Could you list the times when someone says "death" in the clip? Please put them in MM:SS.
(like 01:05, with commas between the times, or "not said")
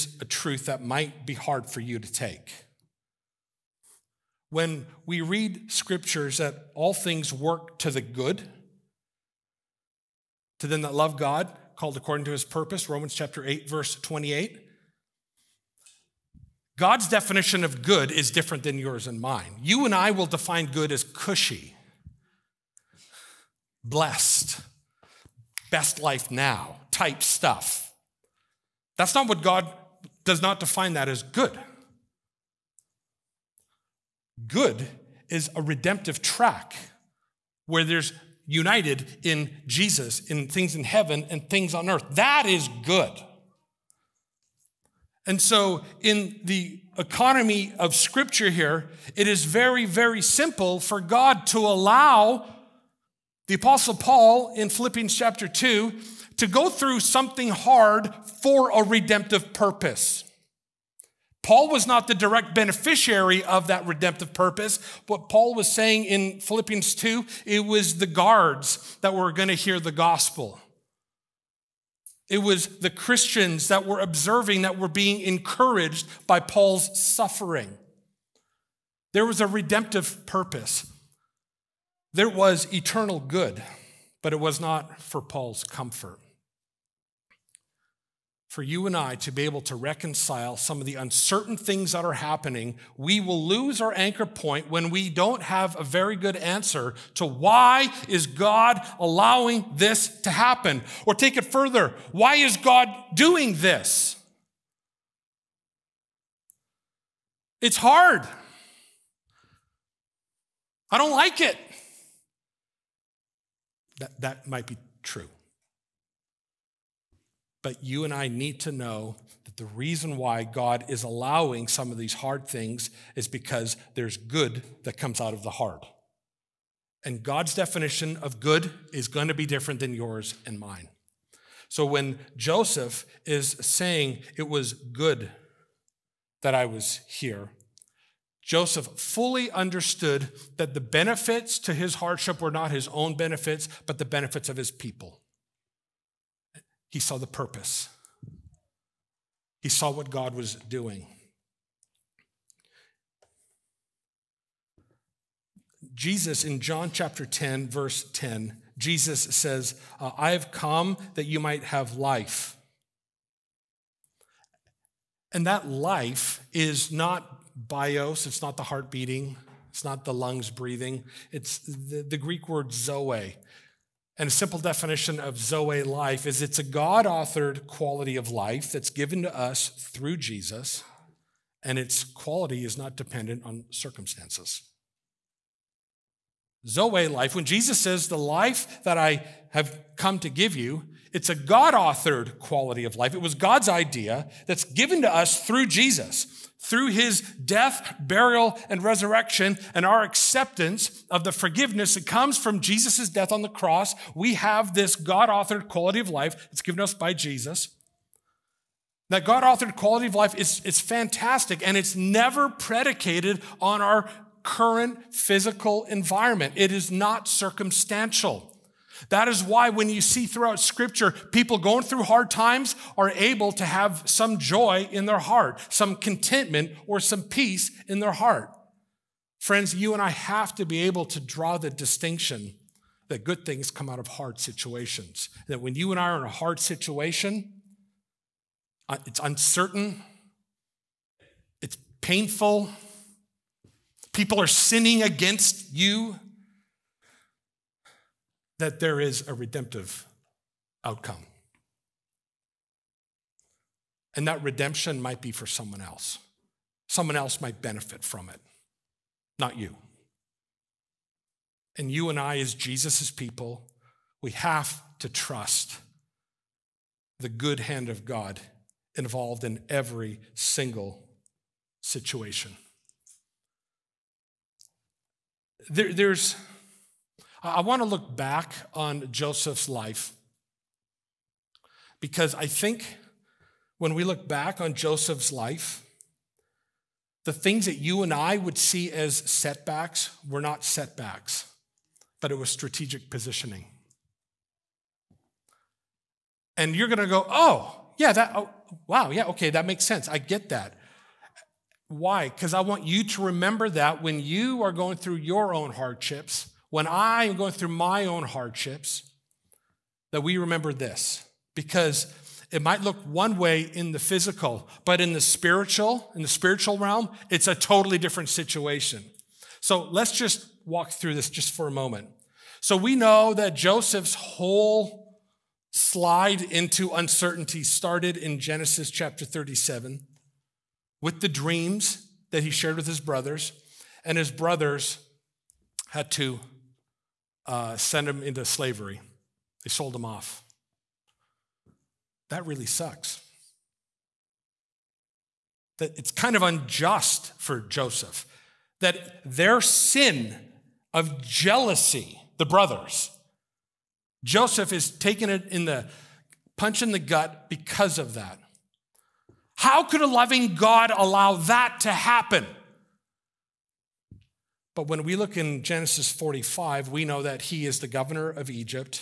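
03:17, 03:23.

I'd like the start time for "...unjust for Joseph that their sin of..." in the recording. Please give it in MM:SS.
05:46.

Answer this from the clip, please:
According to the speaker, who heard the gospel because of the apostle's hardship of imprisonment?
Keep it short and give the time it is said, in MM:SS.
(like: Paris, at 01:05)
The guards, at 01:07.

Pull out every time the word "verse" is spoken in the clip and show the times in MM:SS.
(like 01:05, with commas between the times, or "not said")
00:13, 02:37.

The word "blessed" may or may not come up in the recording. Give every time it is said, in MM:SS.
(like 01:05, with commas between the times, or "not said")
00:23.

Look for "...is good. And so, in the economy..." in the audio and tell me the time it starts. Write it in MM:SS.
00:42.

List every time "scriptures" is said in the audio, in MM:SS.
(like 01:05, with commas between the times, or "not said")
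00:05, 00:47, 03:40.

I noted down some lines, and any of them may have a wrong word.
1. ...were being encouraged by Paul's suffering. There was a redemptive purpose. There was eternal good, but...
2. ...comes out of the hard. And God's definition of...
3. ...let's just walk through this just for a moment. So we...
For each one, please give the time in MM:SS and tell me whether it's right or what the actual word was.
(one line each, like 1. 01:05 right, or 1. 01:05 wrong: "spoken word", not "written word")
1. 01:14 right
2. 02:04 right
3. 05:19 right.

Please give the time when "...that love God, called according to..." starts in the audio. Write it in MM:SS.
00:10.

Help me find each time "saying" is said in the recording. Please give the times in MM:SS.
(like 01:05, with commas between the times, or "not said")
01:05, 02:13.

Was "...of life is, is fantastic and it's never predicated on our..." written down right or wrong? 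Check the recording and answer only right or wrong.
right.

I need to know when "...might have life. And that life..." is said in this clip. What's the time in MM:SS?
02:41.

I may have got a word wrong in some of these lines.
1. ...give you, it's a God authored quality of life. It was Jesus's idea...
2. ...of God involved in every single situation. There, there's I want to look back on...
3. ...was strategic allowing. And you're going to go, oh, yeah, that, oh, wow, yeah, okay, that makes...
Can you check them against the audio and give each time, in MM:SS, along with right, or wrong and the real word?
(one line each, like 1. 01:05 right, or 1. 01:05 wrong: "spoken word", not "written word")
1. 03:10 wrong: "God", not "Jesus"
2. 04:27 right
3. 04:52 wrong: "positioning", not "allowing".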